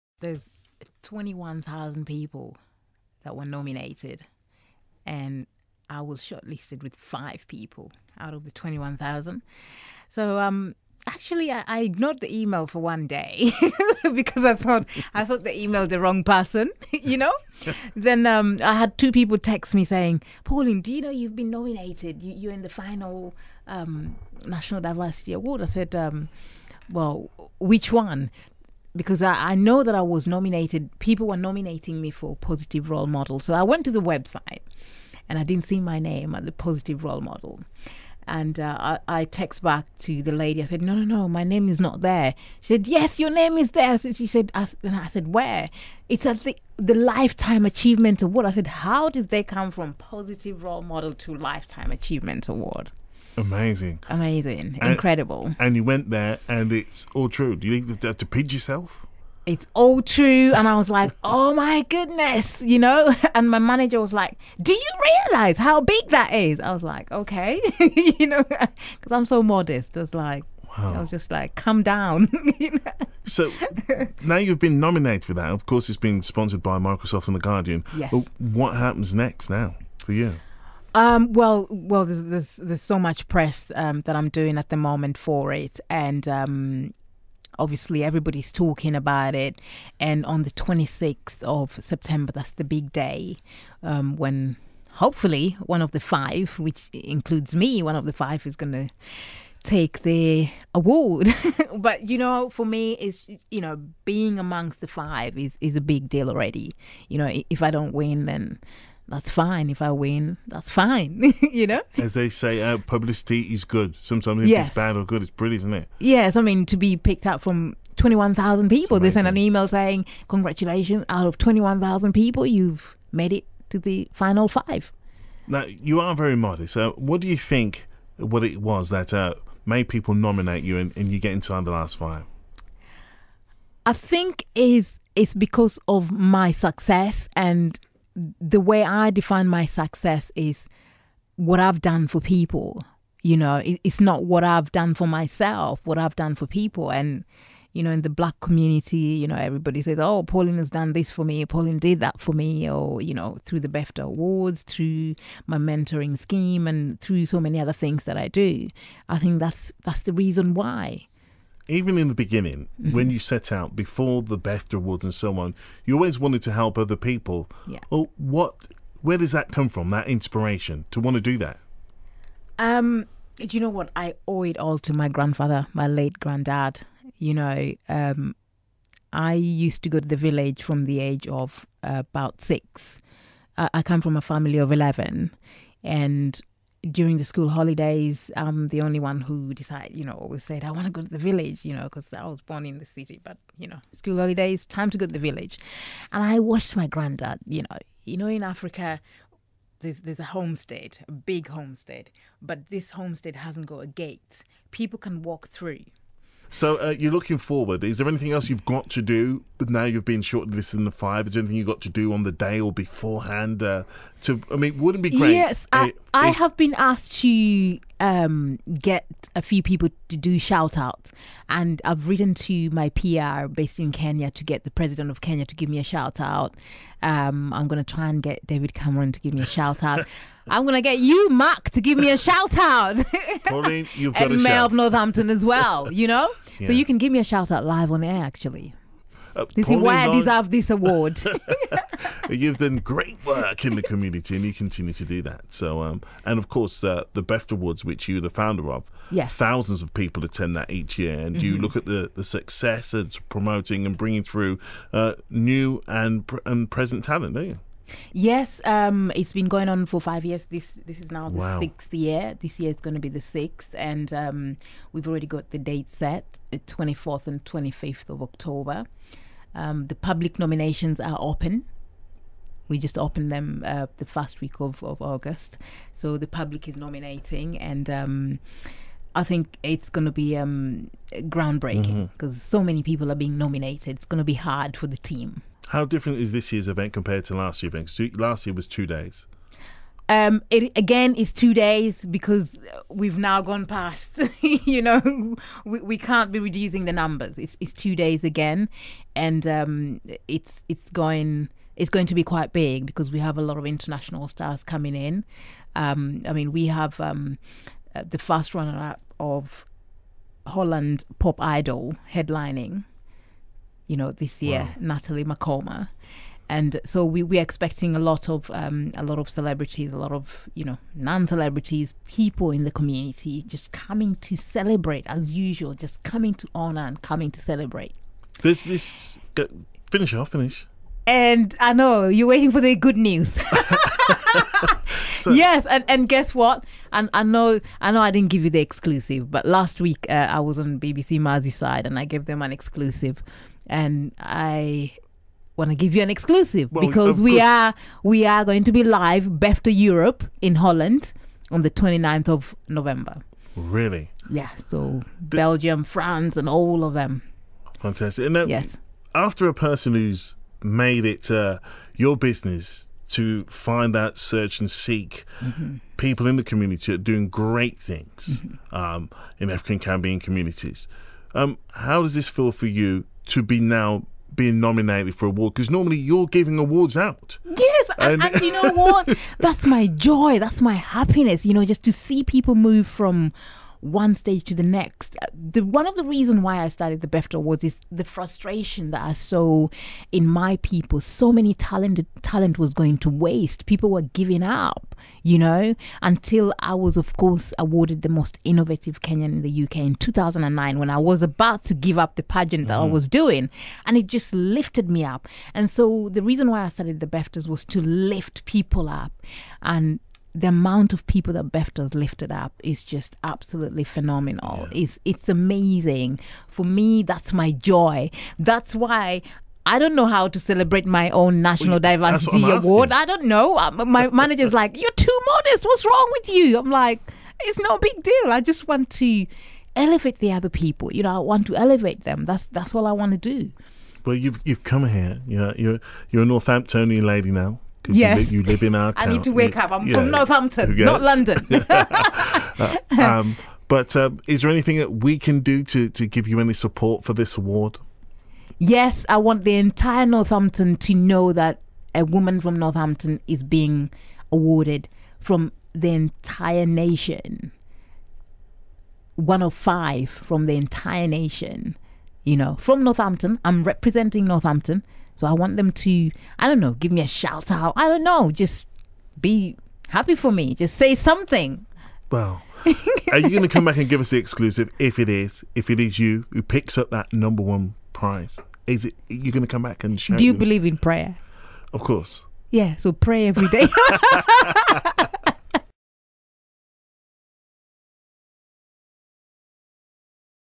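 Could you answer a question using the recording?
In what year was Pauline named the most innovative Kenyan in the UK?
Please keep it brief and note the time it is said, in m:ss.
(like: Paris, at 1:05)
2009, at 6:39.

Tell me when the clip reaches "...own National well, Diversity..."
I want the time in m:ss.
7:01.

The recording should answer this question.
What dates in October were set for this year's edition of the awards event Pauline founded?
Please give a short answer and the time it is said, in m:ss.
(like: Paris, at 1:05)
24th and 25th of October, at 4:26.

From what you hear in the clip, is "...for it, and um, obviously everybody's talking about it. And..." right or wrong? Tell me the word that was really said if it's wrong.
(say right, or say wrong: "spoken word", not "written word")
right.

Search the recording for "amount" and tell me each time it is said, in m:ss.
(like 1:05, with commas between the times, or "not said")
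6:50.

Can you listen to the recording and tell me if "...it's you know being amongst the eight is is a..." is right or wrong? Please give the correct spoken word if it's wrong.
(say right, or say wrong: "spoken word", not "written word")
wrong: "five", not "eight".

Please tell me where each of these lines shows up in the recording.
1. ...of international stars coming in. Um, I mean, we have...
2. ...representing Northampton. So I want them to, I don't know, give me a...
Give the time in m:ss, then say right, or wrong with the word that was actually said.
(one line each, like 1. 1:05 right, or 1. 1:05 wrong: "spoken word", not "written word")
1. 5:03 right
2. 7:43 right.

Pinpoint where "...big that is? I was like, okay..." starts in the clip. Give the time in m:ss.
1:05.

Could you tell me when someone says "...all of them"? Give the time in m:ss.
5:56.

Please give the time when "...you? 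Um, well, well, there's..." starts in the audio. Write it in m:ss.
1:20.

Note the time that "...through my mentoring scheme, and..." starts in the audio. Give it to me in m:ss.
2:34.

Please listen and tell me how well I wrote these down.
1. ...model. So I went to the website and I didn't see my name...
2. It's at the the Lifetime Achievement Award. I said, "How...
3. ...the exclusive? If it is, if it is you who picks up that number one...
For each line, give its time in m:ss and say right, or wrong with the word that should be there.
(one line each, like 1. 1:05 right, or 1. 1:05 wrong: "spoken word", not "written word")
1. 0:33 right
2. 0:46 right
3. 7:54 right.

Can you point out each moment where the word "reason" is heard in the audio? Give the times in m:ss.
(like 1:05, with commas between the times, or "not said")
2:40, 6:26, 6:46.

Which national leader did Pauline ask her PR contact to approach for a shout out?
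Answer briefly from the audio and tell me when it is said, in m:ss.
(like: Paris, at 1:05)
President of Kenya, at 3:44.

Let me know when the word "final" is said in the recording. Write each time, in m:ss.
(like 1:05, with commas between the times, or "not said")
0:22, 2:04.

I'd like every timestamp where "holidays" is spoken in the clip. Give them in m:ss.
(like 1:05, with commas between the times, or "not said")
3:07, 3:14.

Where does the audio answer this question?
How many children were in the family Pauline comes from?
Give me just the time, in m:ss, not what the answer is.
3:04.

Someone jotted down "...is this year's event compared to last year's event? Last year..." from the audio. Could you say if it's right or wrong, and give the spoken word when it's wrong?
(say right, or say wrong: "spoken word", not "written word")
right.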